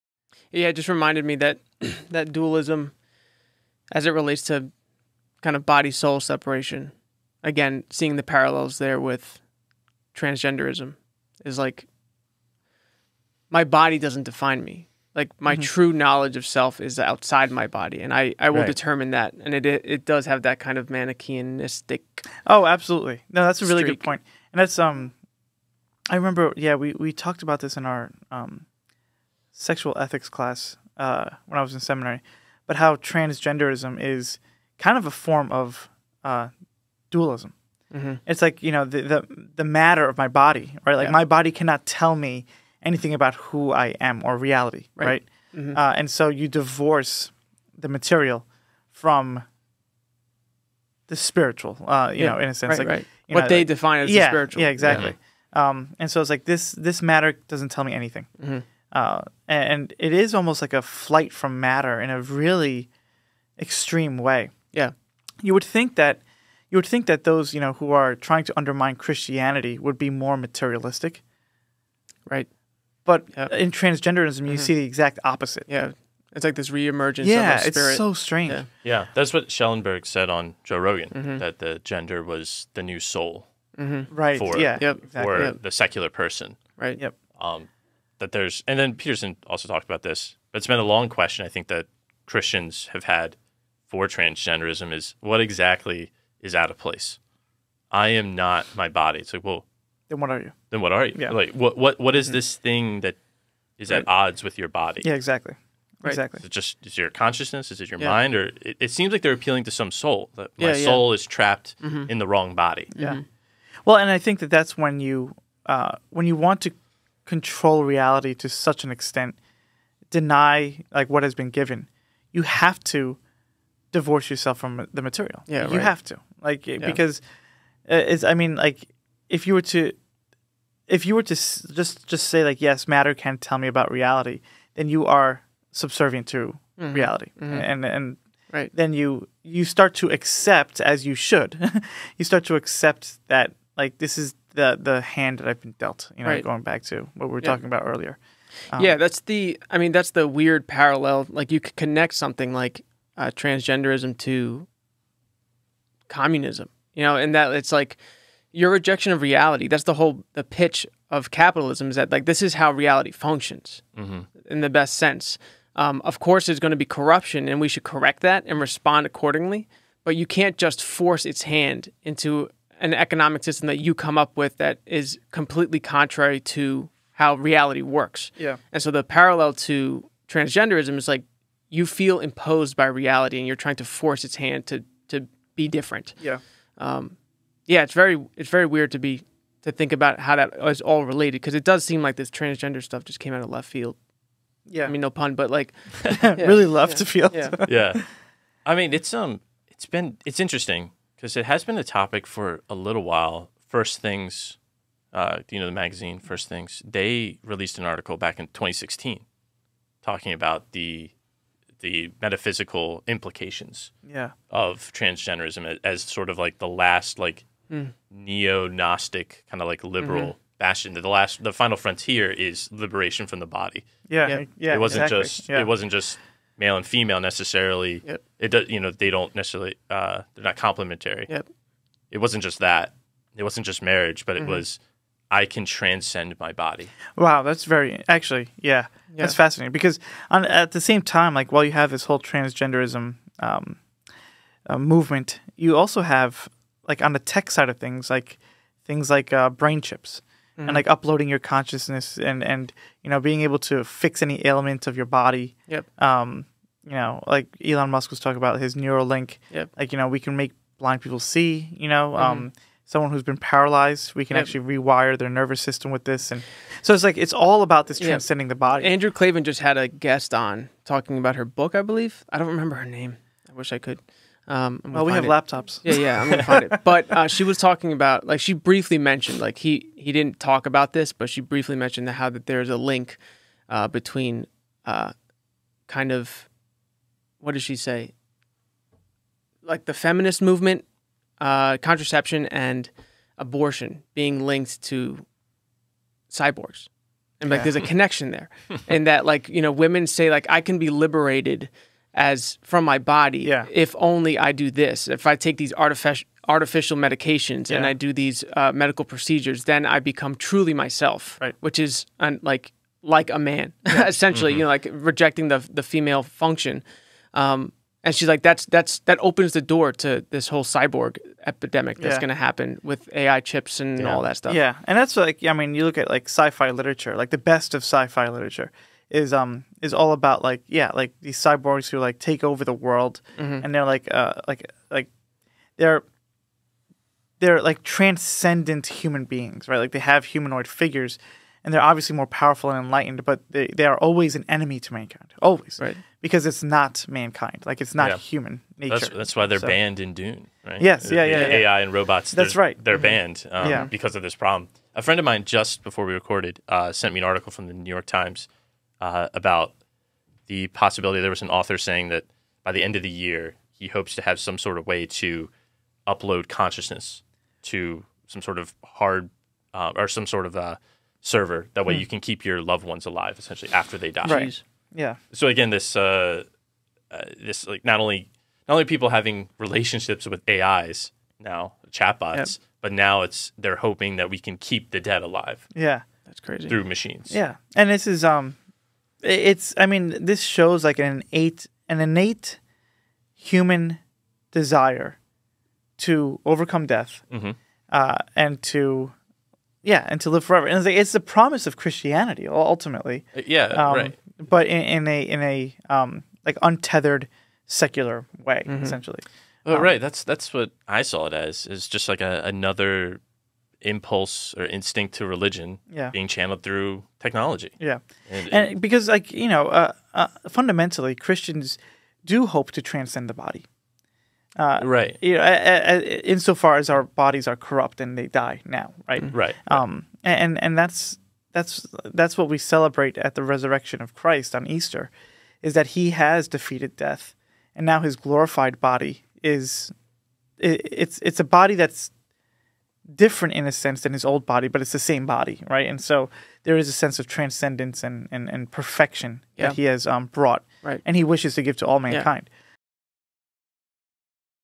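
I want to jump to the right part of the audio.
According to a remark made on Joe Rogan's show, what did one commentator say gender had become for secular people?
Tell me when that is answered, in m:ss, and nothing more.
1:21.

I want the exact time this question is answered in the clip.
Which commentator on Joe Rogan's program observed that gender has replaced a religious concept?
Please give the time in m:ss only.
1:19.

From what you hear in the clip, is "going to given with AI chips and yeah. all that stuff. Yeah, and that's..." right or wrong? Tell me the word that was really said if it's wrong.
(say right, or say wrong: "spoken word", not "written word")
wrong: "happen", not "given".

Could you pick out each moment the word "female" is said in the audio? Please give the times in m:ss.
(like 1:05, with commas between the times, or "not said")
3:46, 5:15.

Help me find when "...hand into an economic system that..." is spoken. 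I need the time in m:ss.
2:51.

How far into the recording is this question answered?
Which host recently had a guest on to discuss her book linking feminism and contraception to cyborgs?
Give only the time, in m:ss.
4:28.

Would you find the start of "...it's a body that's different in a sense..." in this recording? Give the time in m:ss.
7:21.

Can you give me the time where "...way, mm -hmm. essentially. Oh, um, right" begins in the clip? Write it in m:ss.
6:48.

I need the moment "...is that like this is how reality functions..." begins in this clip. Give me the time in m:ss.
2:41.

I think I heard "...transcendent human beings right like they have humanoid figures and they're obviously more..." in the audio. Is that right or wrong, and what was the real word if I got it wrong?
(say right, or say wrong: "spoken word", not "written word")
right.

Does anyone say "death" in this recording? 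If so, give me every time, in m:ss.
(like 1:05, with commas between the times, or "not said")
6:36, 7:16.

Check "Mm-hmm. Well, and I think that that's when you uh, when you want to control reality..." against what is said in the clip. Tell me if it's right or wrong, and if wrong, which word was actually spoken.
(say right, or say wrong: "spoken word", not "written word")
right.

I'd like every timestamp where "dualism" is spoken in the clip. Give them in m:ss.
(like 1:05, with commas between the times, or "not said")
0:02, 0:37.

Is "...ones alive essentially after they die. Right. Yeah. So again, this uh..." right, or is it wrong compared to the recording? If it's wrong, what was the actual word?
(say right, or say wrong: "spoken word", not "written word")
right.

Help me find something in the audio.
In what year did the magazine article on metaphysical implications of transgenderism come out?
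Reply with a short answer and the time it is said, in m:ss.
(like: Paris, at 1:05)
2016, at 3:28.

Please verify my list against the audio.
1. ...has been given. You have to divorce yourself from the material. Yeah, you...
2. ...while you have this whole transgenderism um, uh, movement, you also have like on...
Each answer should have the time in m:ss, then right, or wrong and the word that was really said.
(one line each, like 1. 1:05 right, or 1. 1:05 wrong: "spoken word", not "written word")
1. 2:01 right
2. 4:01 right.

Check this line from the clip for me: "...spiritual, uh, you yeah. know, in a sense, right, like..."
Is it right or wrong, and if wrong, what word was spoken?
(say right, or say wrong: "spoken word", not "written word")
right.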